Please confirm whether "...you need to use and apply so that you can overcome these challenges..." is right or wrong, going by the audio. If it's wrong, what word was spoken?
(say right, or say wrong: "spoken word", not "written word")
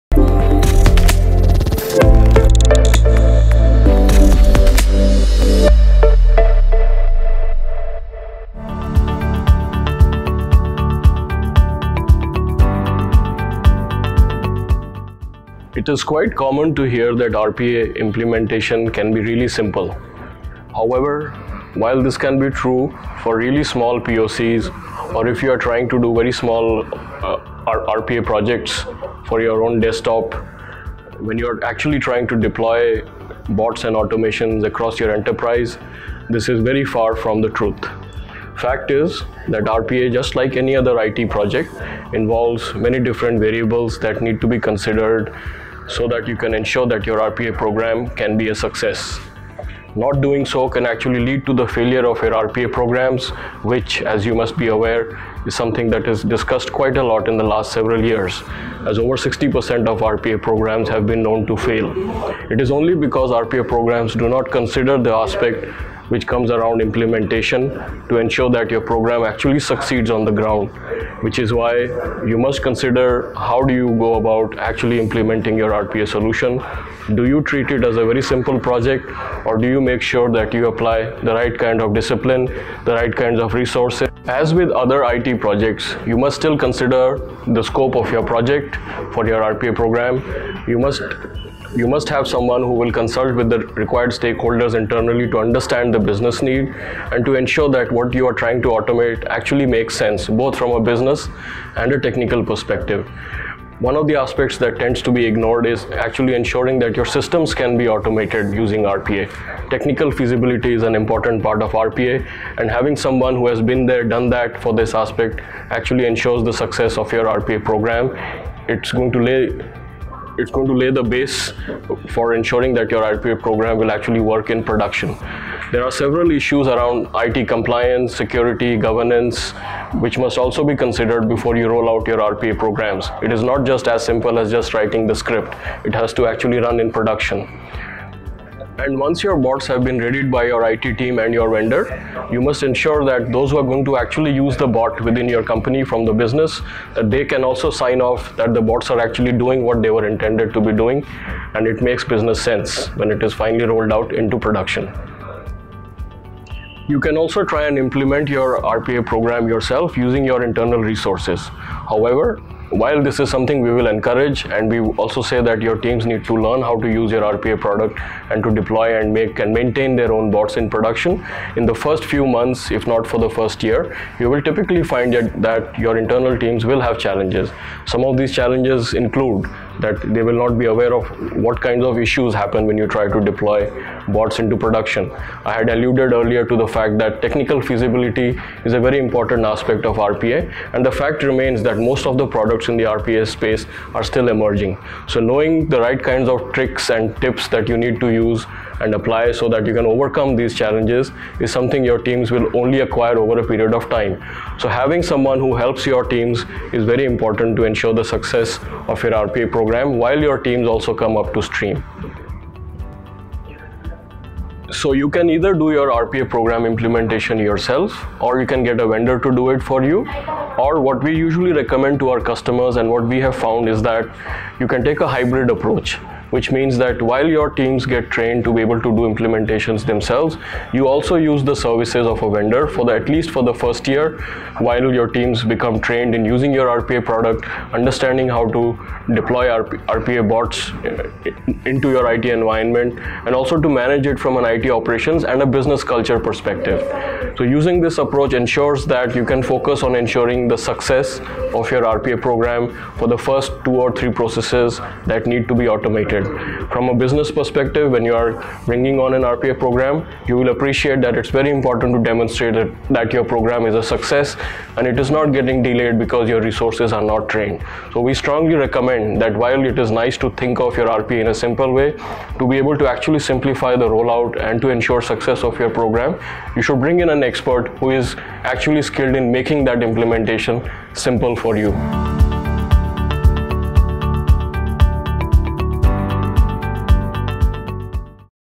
right.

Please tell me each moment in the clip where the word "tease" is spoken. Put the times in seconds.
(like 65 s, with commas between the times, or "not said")
not said.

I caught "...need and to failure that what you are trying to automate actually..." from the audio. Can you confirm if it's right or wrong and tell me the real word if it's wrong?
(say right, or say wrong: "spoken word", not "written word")
wrong: "ensure", not "failure".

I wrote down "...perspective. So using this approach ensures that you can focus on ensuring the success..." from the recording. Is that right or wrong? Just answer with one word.
right.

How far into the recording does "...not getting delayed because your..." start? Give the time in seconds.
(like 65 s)
265 s.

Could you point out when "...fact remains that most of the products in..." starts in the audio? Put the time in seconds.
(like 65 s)
190 s.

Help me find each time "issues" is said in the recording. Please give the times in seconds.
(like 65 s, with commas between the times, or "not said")
126 s, 181 s.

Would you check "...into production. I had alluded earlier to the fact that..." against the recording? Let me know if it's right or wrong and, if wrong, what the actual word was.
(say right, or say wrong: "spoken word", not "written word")
right.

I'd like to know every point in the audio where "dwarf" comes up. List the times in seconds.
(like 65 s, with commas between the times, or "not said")
not said.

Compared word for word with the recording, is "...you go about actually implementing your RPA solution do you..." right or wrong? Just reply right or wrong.
right.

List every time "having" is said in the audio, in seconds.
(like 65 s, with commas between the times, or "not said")
112 s, 204 s.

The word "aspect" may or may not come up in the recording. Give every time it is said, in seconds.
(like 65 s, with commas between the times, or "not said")
65 s, 104 s, 114 s, 189 s.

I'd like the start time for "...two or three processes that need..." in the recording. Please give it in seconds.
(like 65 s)
253 s.